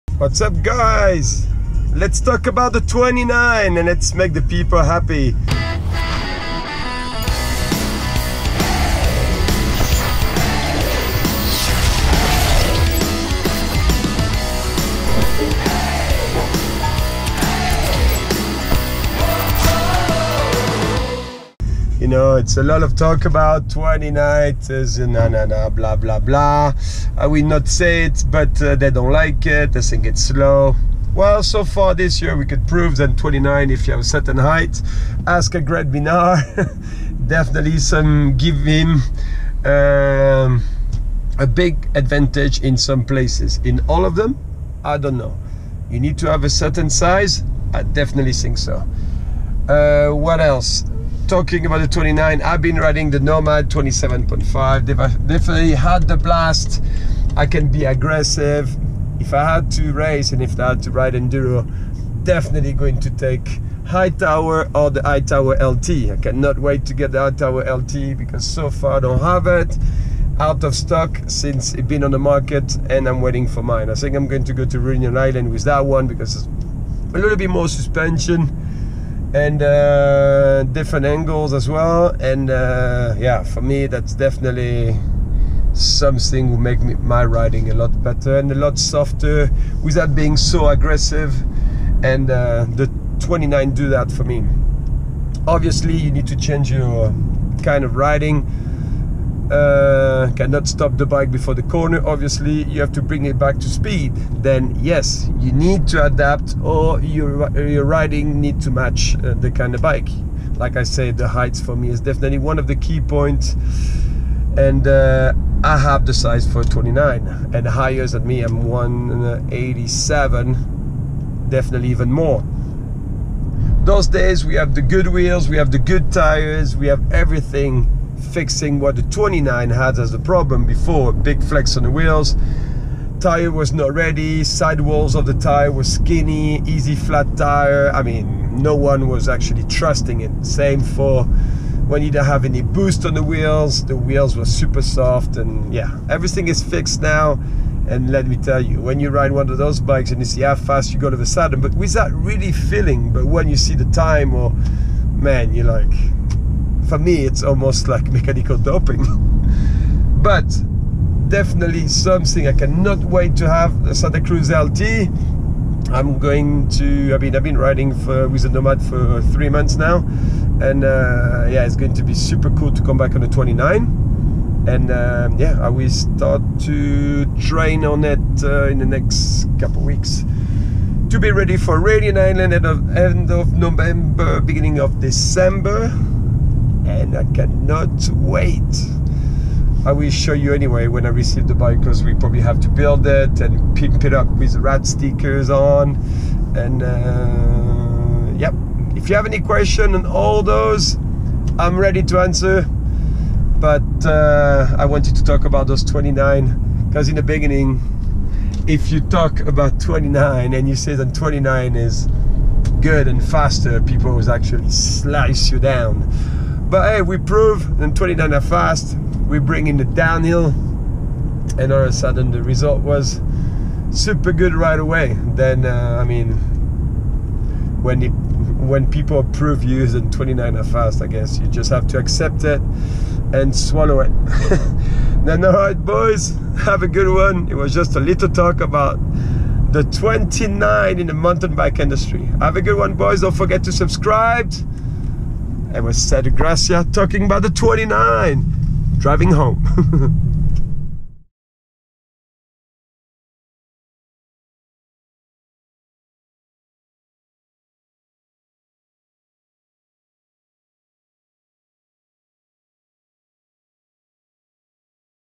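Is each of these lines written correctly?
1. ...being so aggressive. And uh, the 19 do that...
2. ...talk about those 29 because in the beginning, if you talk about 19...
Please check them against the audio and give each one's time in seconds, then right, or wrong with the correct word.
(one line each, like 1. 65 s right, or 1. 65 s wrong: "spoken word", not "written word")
1. 90 s wrong: "29", not "19"
2. 205 s wrong: "29", not "19".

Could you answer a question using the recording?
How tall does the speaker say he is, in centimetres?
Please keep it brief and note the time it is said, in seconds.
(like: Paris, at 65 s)
187, at 118 s.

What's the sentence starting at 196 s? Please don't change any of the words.
And uh, yep, if you have any question on all those, I'm ready to answer.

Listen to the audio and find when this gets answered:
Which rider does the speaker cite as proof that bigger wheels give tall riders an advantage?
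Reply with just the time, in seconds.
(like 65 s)
35 s.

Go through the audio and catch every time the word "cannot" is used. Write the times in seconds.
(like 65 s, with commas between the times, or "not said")
66 s, 100 s, 162 s, 187 s.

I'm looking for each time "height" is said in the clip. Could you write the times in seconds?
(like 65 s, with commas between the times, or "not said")
34 s, 111 s.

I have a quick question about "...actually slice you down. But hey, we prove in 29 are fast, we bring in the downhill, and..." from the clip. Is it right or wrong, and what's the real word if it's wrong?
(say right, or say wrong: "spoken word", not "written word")
right.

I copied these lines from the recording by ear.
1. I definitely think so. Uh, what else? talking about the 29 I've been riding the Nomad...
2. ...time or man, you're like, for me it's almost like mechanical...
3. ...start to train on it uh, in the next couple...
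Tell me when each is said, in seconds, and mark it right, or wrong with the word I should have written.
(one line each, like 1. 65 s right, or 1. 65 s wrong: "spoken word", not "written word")
1. 47 s right
2. 153 s right
3. 175 s right.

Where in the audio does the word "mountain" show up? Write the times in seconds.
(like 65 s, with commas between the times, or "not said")
241 s.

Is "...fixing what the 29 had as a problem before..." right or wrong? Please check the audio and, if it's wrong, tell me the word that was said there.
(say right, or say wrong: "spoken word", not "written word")
right.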